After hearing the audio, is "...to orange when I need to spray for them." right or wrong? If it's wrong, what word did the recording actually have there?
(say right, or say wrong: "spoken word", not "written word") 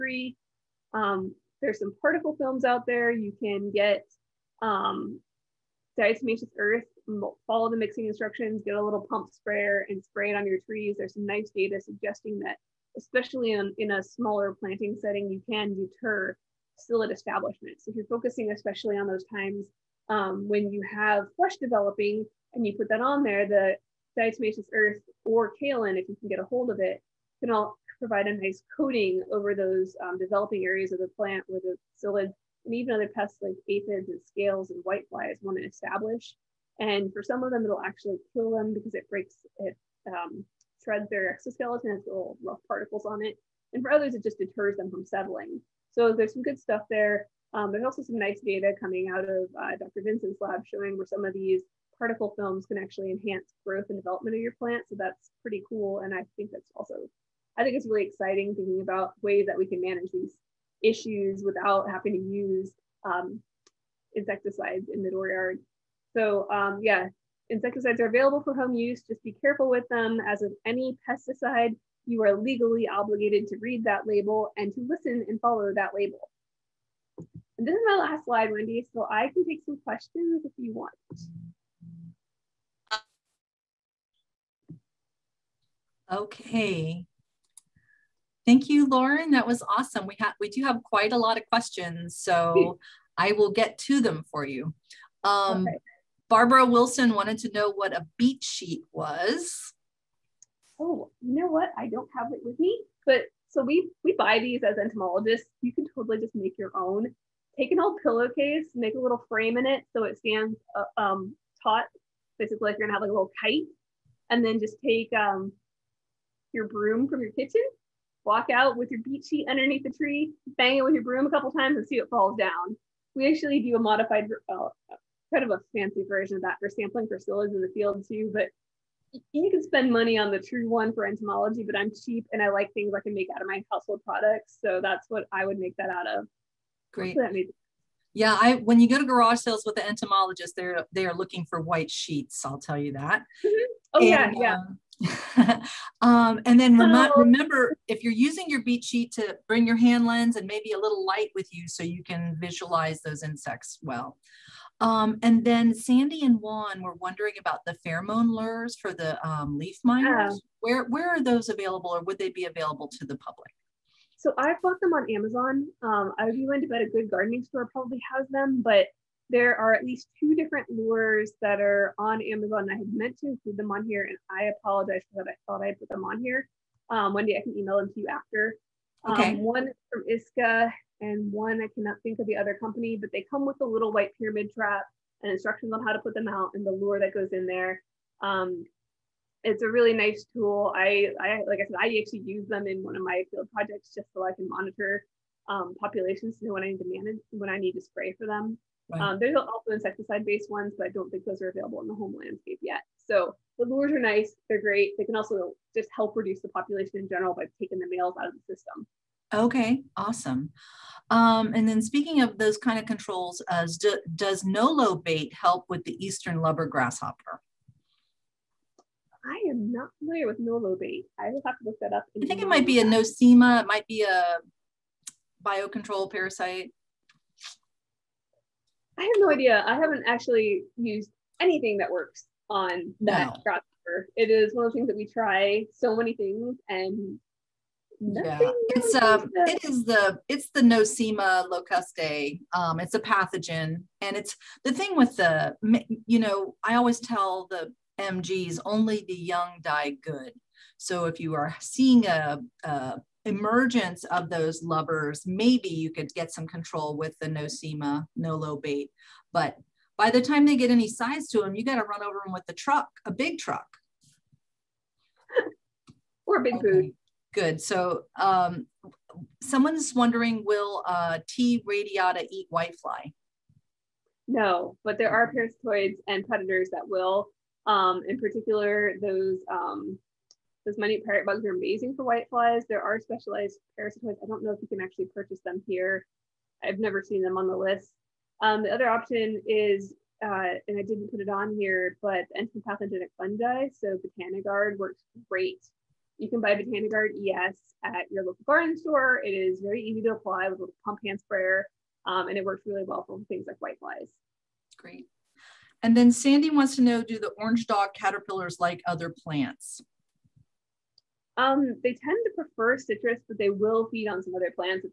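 wrong: "manage", not "orange".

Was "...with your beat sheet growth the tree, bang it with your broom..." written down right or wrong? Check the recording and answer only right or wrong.
wrong.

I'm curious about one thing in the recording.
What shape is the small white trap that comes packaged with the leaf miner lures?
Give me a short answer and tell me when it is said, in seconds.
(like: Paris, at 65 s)
pyramid, at 184 s.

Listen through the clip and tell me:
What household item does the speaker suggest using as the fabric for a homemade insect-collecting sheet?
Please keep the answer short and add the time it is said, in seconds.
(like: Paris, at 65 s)
old pillowcase, at 107 s.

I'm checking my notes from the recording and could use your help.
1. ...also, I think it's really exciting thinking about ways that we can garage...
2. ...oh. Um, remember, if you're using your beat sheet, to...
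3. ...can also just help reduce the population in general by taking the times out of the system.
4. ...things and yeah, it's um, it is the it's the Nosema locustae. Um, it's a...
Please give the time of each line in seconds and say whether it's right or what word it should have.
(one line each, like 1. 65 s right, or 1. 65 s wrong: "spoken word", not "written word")
1. 56 s wrong: "manage", not "garage"
2. 146 s right
3. 205 s wrong: "males", not "times"
4. 236 s right.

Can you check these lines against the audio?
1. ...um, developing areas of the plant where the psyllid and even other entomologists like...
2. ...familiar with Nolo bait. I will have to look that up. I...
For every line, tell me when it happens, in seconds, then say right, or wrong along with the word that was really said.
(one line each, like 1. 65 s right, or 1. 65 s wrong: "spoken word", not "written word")
1. 30 s wrong: "pests", not "entomologists"
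2. 219 s right.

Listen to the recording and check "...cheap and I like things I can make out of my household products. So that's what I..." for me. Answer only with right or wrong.
right.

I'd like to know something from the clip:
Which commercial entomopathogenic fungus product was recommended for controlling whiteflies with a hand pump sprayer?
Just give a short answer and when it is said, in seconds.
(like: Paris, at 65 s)
Botanigard ES, at 296 s.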